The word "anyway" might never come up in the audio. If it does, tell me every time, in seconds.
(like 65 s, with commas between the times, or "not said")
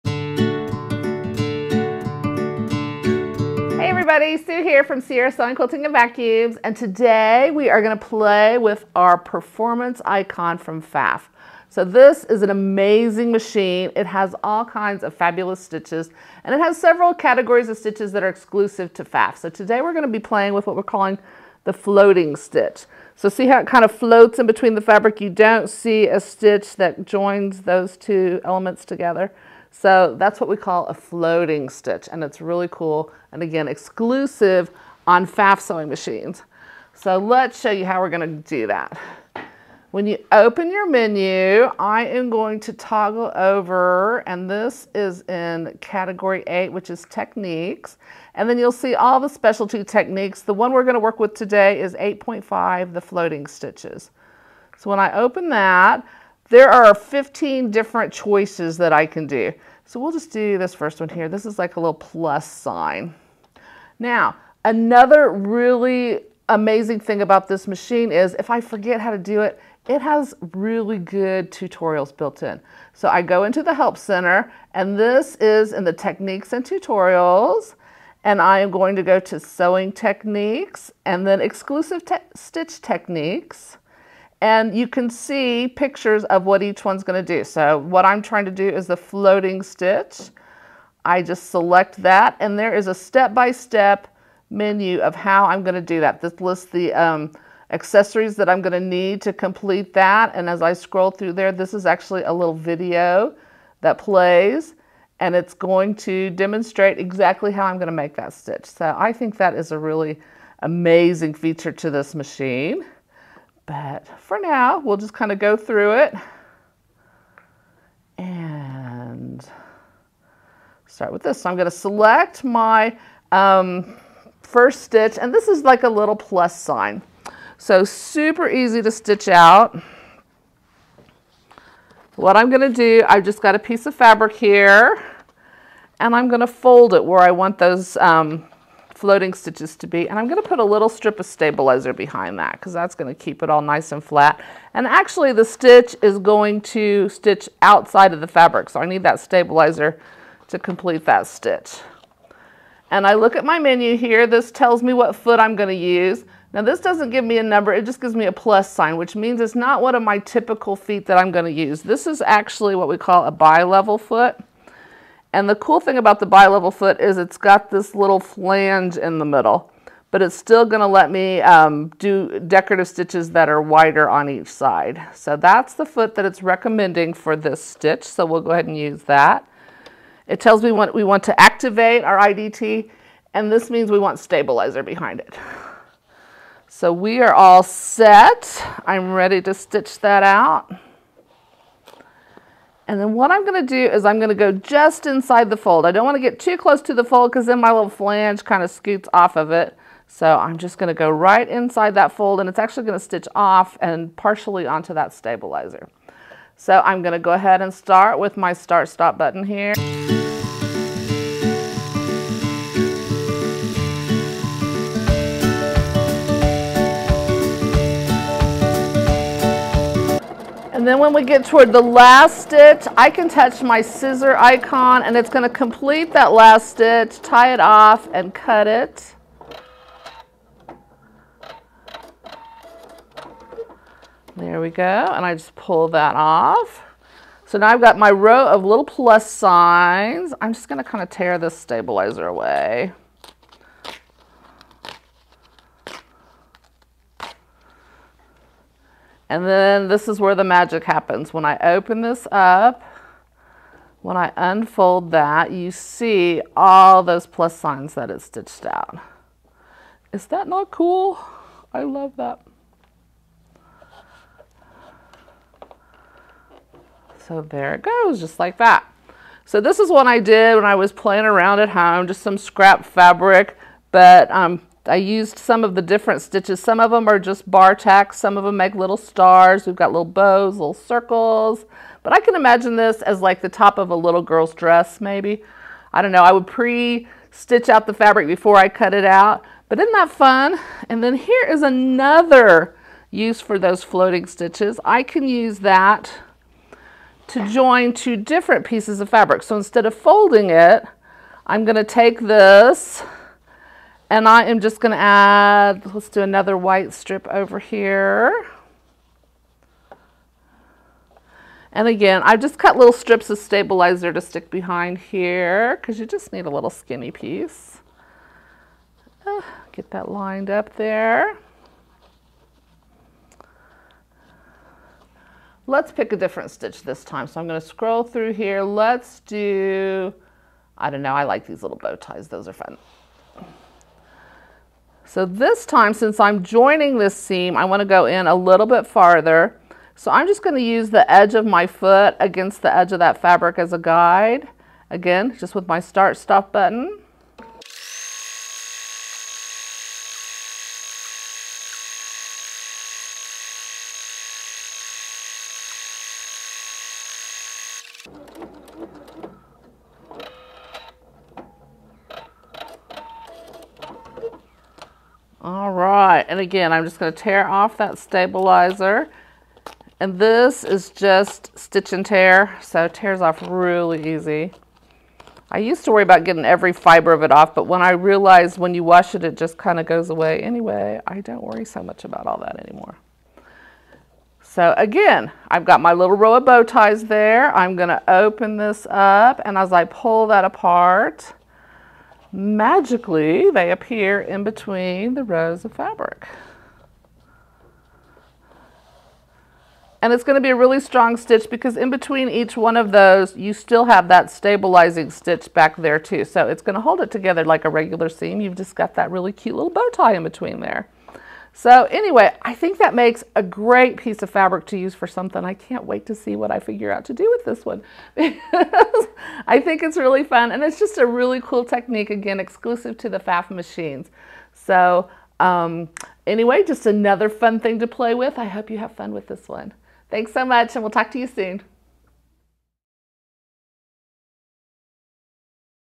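380 s, 411 s, 426 s.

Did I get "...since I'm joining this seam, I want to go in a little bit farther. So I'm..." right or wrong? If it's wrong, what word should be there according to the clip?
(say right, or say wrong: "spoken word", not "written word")
right.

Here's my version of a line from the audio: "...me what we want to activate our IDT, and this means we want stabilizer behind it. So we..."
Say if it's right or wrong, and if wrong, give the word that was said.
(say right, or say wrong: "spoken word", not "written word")
right.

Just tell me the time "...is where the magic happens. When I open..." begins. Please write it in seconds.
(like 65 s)
250 s.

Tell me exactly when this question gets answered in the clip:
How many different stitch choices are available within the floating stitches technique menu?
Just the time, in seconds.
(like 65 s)
56 s.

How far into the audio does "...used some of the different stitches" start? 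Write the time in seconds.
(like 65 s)
274 s.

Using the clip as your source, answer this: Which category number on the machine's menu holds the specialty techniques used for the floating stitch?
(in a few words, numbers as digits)
8.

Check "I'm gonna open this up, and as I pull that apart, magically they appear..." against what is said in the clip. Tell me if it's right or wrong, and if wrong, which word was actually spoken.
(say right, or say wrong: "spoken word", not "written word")
right.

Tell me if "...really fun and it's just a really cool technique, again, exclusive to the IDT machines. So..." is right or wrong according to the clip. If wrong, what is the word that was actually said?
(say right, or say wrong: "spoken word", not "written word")
wrong: "Pfaff", not "IDT".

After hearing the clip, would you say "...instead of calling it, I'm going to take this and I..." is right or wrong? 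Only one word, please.
wrong.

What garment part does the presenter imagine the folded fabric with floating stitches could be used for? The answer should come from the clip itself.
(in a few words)
top of a little girl's dress.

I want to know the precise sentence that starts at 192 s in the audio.
And then what I'm going to do is I'm going to go just inside the fold.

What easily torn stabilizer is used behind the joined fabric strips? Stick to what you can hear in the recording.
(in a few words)
stitch and tear.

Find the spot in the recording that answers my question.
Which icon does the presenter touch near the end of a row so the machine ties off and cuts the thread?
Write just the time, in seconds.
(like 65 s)
223 s.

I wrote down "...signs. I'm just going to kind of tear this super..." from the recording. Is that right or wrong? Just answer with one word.
wrong.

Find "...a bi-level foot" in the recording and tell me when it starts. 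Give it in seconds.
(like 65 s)
163 s.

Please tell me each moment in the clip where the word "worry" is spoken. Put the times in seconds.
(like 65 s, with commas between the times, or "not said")
375 s, 381 s.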